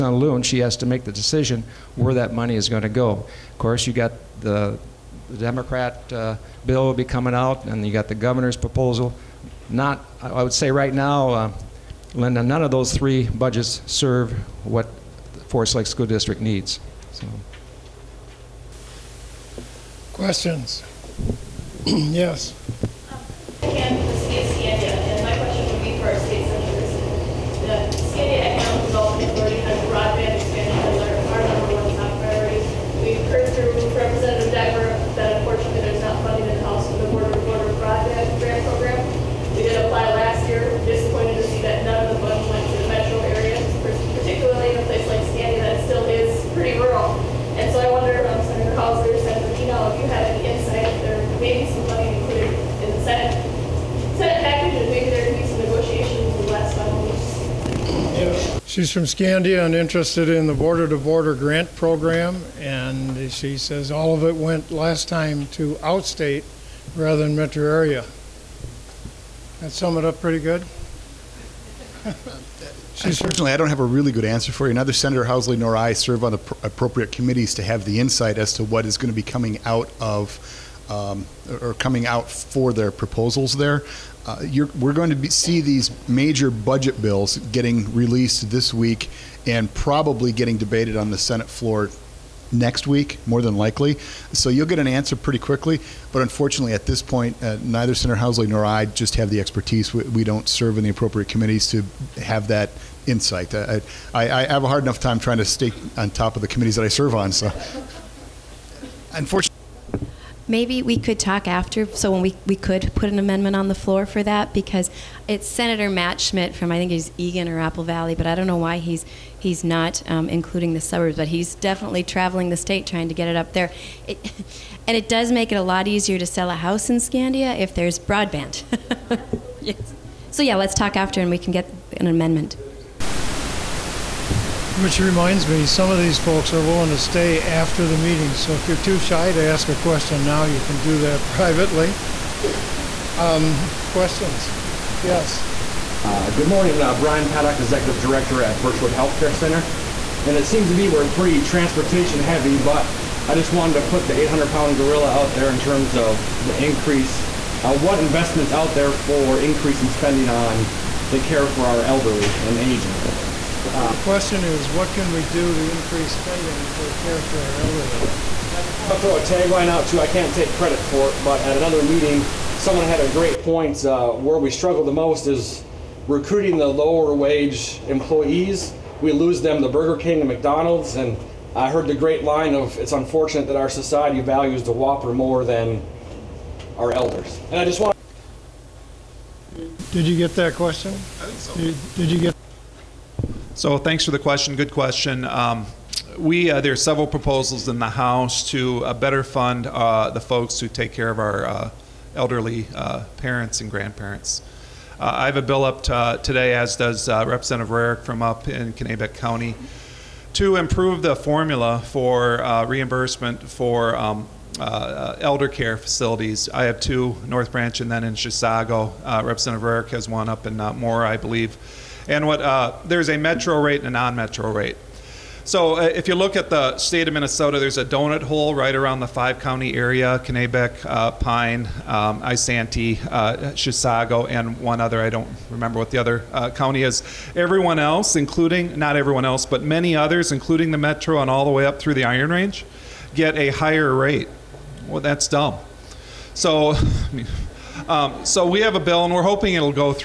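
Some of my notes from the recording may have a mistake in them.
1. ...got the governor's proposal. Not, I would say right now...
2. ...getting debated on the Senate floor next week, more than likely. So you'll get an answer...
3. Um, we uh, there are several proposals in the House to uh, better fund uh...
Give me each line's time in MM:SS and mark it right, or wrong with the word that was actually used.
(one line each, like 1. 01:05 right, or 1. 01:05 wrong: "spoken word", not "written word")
1. 00:07 right
2. 01:30 right
3. 03:15 right.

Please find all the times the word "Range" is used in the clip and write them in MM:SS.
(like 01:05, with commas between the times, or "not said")
04:02.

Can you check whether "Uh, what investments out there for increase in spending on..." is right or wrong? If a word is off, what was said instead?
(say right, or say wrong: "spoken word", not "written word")
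right.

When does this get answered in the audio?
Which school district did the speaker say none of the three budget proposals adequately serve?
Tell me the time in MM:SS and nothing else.
00:15.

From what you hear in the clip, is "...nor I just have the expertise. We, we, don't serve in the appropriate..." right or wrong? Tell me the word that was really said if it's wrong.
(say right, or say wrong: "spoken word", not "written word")
right.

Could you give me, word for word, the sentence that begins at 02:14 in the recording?
Which reminds me, some of these folks are willing to stay after the meeting.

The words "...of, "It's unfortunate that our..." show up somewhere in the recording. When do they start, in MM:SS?
03:02.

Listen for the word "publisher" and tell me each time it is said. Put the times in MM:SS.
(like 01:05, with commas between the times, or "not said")
not said.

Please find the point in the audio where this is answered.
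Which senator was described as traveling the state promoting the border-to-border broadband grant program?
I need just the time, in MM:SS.
01:55.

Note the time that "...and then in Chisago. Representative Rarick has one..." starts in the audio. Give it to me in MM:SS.
03:37.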